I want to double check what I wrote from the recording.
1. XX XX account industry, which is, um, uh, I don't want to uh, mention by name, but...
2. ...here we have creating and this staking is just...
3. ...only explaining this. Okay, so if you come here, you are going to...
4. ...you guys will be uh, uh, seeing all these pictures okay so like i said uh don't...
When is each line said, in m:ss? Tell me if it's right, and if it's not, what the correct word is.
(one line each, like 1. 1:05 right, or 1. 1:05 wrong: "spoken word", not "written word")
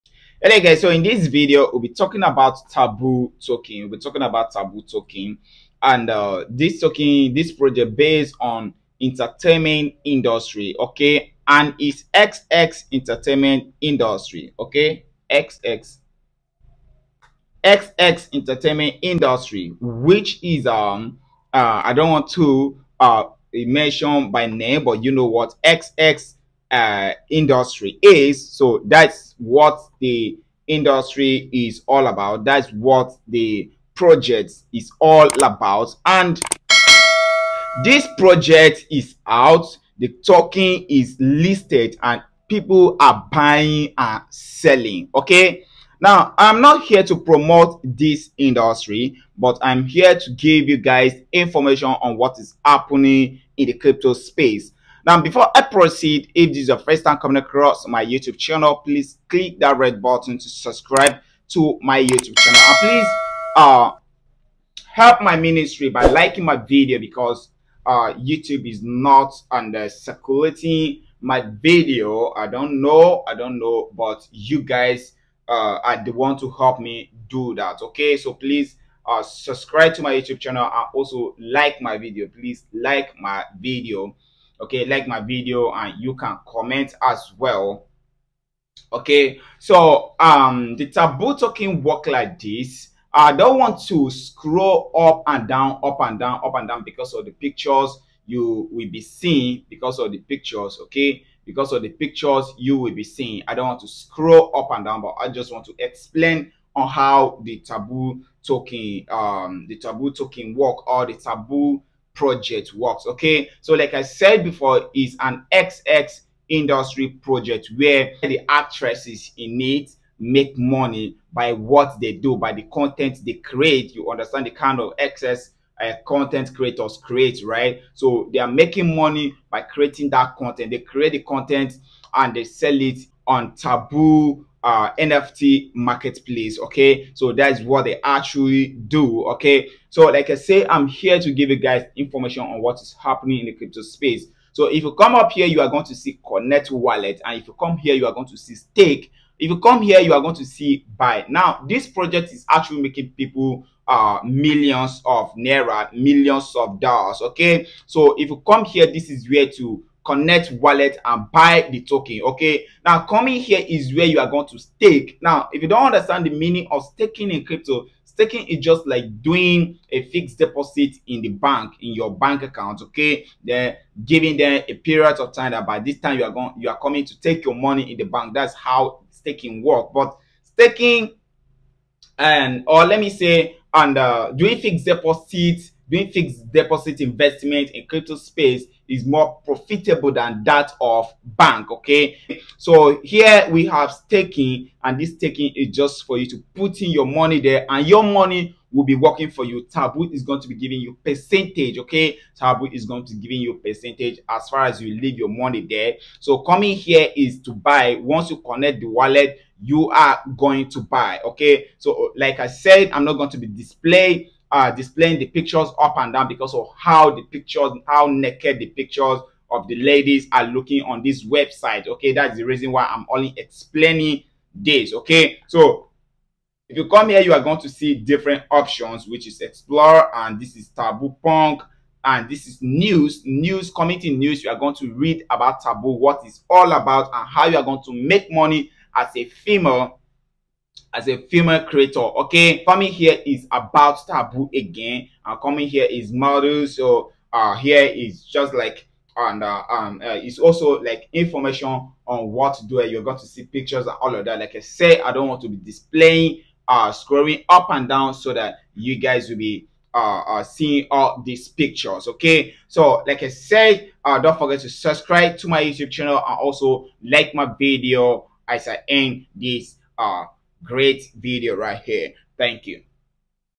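1. 0:15 wrong: "entertainment", not "account"
2. 3:13 wrong: "staking", not "creating"
3. 3:43 right
4. 4:18 right.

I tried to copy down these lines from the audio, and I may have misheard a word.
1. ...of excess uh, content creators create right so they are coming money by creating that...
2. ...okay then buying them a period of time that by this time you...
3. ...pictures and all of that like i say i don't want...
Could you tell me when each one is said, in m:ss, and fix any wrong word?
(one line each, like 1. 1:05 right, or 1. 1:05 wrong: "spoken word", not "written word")
1. 2:04 wrong: "making", not "coming"
2. 2:52 wrong: "giving", not "buying"
3. 4:13 right.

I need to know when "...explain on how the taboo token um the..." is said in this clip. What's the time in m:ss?
1:45.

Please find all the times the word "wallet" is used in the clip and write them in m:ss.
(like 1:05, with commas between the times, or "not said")
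2:26, 2:40, 3:28.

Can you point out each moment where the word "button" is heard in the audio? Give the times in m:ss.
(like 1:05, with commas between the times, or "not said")
1:00.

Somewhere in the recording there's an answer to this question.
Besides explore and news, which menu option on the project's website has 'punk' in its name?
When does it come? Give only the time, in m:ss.
3:50.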